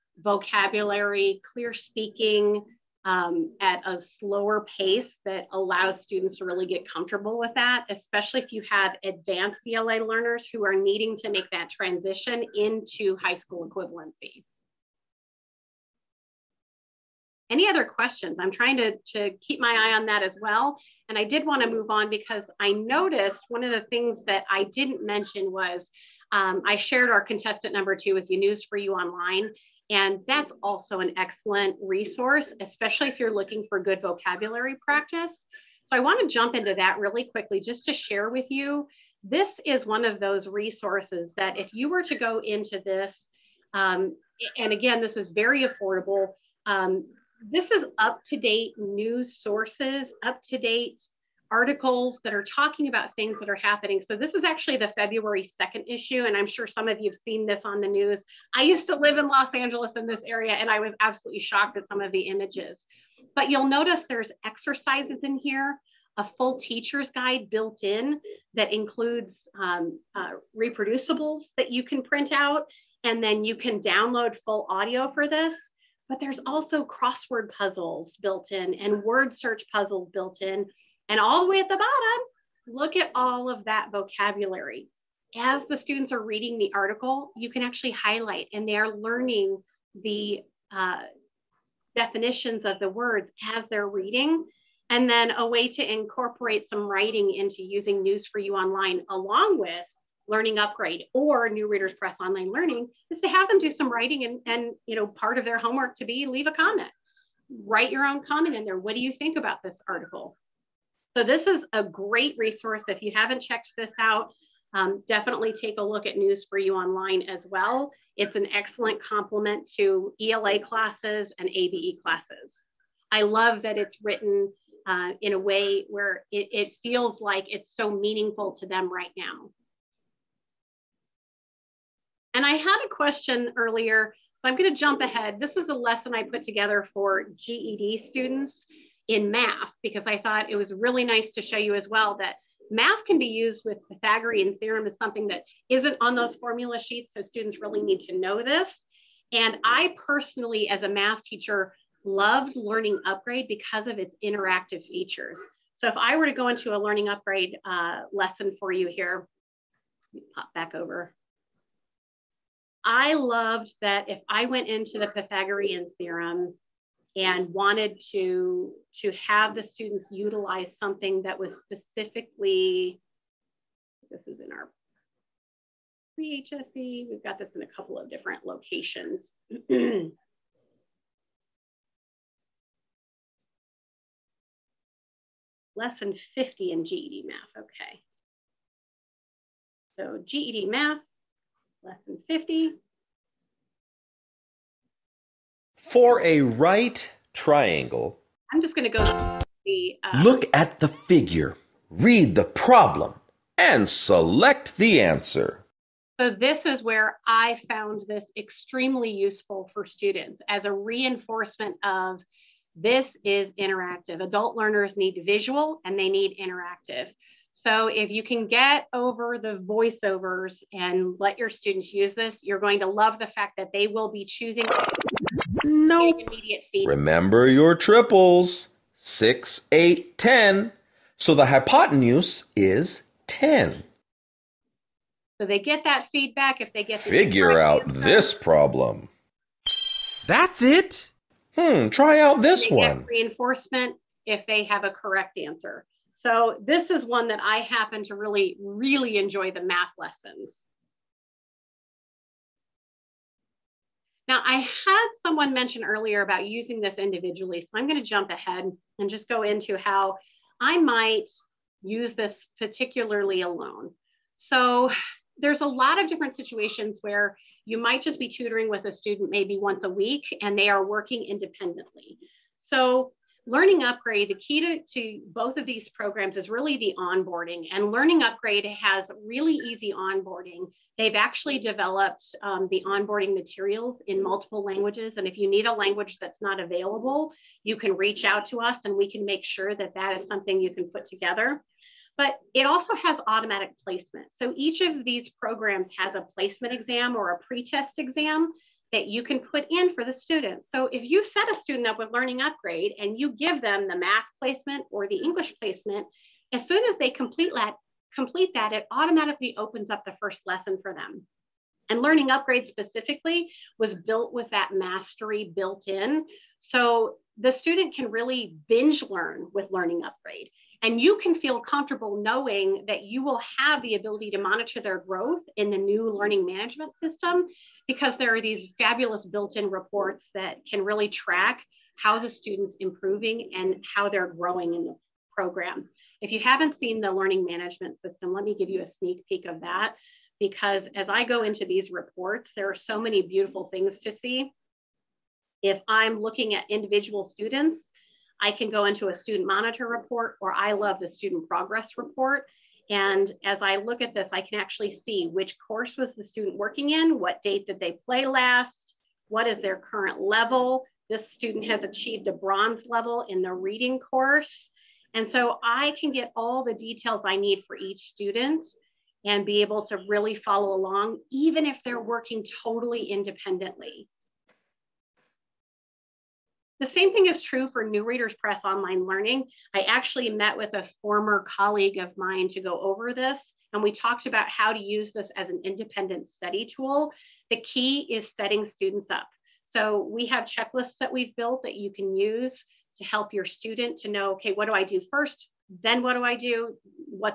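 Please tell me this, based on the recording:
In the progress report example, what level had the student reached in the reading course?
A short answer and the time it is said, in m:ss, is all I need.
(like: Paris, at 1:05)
bronze, at 6:02.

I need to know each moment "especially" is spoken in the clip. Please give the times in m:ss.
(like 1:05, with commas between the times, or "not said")
0:07, 0:32.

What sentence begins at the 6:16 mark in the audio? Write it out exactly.
The same thing is true for New Readers Press online learning.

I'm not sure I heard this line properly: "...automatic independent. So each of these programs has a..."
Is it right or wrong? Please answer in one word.
wrong.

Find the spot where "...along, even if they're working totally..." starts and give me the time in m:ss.
6:10.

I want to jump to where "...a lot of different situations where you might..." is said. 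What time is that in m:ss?
4:25.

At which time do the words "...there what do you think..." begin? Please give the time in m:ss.
1:48.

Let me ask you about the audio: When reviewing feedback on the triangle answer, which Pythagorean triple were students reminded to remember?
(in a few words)
6, 8, 10.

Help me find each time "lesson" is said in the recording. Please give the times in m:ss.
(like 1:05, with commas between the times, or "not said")
2:15, 2:38, 3:05, 3:11, 4:09, 5:10.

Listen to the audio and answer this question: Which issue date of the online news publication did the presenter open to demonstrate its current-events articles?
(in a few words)
February 2nd.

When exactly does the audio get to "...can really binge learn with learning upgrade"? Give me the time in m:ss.
5:17.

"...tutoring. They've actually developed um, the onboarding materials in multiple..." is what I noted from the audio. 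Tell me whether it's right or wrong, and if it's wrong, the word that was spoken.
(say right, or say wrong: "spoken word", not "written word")
wrong: "onboarding", not "tutoring".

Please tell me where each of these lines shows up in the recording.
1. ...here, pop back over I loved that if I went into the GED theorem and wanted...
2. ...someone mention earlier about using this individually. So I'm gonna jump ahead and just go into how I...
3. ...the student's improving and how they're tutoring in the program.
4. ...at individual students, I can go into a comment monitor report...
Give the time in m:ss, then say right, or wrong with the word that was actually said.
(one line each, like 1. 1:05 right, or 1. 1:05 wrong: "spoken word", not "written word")
1. 2:38 wrong: "Pythagorean", not "GED"
2. 4:15 right
3. 5:32 wrong: "growing", not "tutoring"
4. 5:46 wrong: "student", not "comment".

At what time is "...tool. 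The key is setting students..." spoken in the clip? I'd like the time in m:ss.
6:26.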